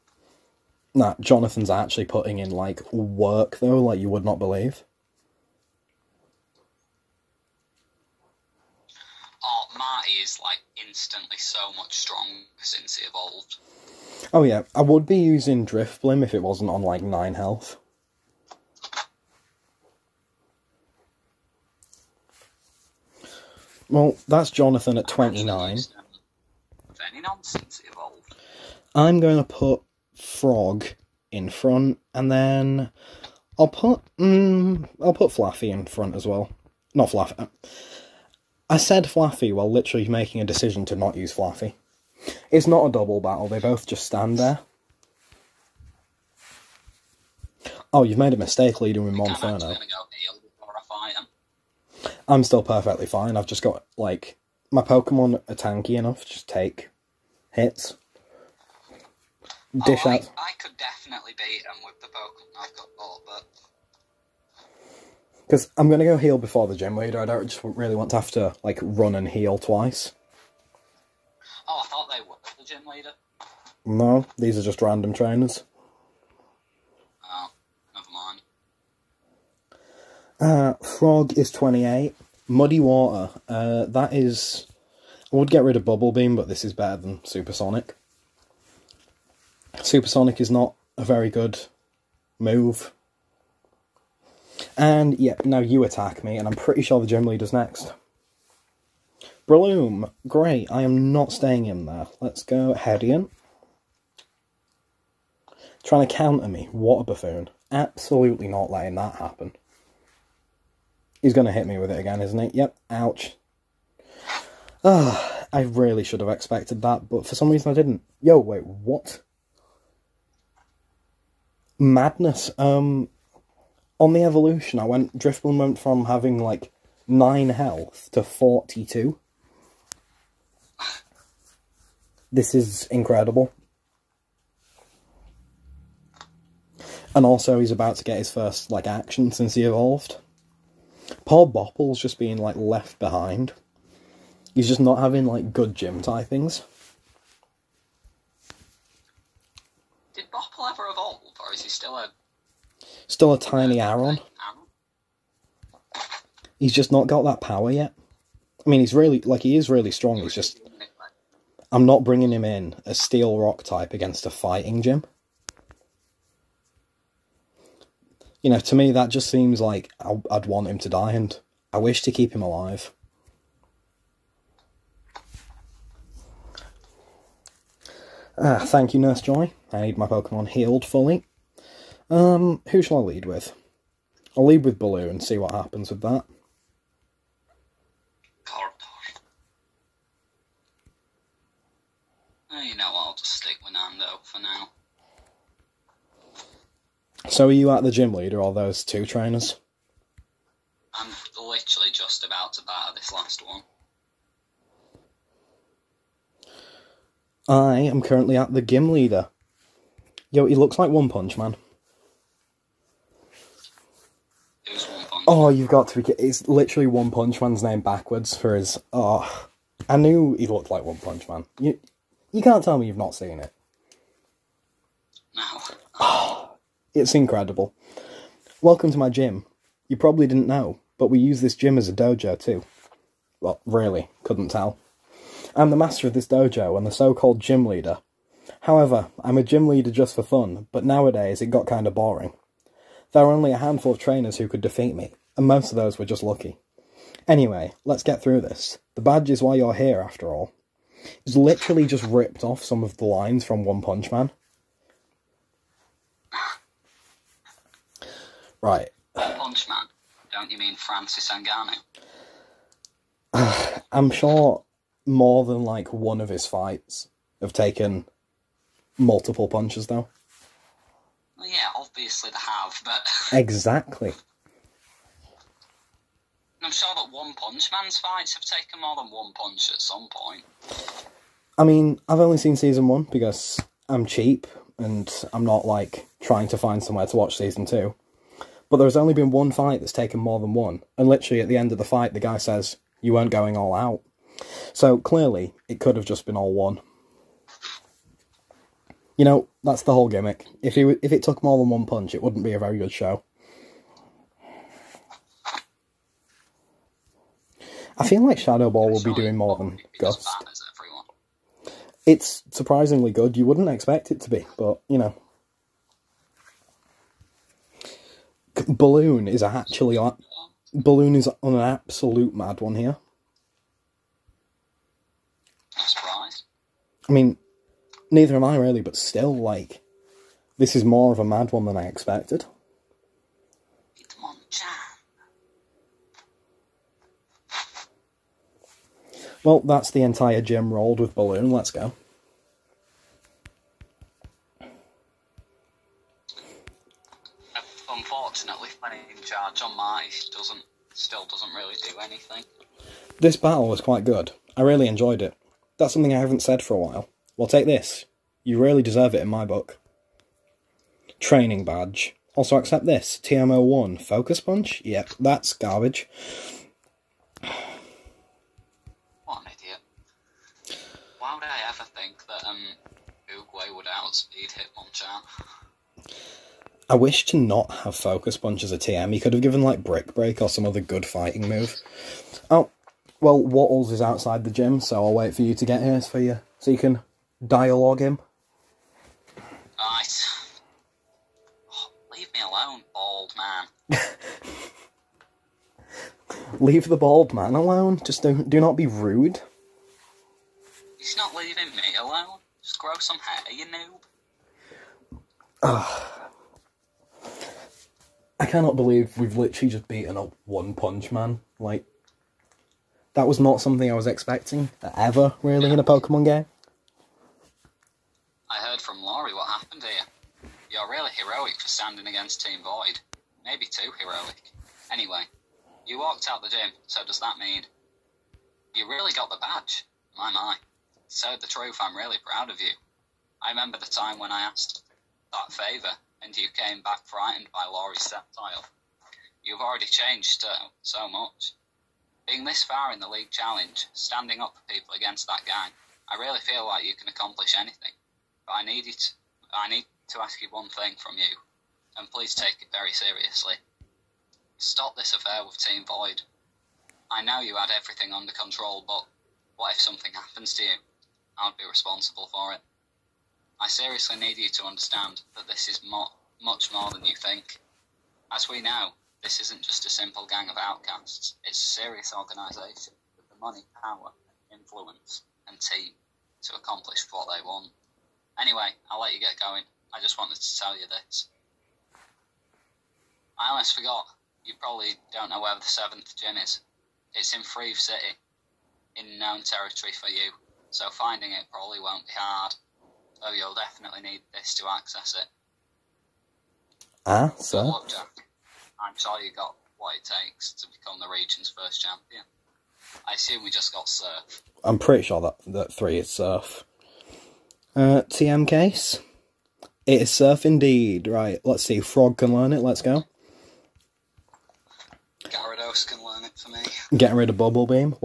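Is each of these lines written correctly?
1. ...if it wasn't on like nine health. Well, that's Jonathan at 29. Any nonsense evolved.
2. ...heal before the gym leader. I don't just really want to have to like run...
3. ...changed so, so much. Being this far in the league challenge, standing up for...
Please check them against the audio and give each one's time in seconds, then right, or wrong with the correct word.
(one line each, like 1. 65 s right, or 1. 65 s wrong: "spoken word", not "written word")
1. 16 s right
2. 66 s right
3. 439 s right.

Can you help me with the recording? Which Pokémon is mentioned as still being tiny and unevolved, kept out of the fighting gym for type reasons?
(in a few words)
Aron.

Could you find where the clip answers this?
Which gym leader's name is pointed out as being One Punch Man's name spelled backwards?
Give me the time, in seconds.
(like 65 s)
334 s.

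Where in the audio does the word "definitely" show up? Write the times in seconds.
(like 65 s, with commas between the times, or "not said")
60 s, 493 s.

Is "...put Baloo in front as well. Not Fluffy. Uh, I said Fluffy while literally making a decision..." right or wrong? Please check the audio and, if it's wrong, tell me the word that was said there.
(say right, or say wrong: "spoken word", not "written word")
wrong: "Fluffy", not "Baloo".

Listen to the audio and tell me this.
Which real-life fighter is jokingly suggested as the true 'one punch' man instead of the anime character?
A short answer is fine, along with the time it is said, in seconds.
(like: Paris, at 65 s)
Francis Ngannou, at 260 s.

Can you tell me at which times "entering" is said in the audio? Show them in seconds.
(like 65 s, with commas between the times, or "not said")
not said.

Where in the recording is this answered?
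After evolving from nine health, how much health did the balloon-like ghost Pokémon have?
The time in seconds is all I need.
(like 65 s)
128 s.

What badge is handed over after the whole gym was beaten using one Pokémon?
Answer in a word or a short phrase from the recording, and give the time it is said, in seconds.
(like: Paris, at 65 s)
Training badge, at 361 s.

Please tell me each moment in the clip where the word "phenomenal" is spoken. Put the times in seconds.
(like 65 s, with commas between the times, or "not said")
not said.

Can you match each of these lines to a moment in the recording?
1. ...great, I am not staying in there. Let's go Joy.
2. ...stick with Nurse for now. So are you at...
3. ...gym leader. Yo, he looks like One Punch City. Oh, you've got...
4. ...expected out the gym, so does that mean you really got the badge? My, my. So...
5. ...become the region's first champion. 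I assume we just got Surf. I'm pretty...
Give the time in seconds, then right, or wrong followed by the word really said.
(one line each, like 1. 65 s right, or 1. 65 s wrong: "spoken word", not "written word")
1. 100 s wrong: "Hedian", not "Joy"
2. 193 s wrong: "Nando", not "Nurse"
3. 208 s wrong: "Man", not "City"
4. 426 s wrong: "walked", not "expected"
5. 500 s right.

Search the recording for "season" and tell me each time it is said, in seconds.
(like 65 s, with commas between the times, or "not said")
282 s, 287 s.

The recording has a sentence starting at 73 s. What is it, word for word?
No, these are just random trainers.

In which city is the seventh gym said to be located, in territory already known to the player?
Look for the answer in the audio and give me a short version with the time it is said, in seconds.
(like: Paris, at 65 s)
Freve City, at 487 s.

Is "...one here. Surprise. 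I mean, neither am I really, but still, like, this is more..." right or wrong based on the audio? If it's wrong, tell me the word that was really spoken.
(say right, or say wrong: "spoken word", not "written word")
right.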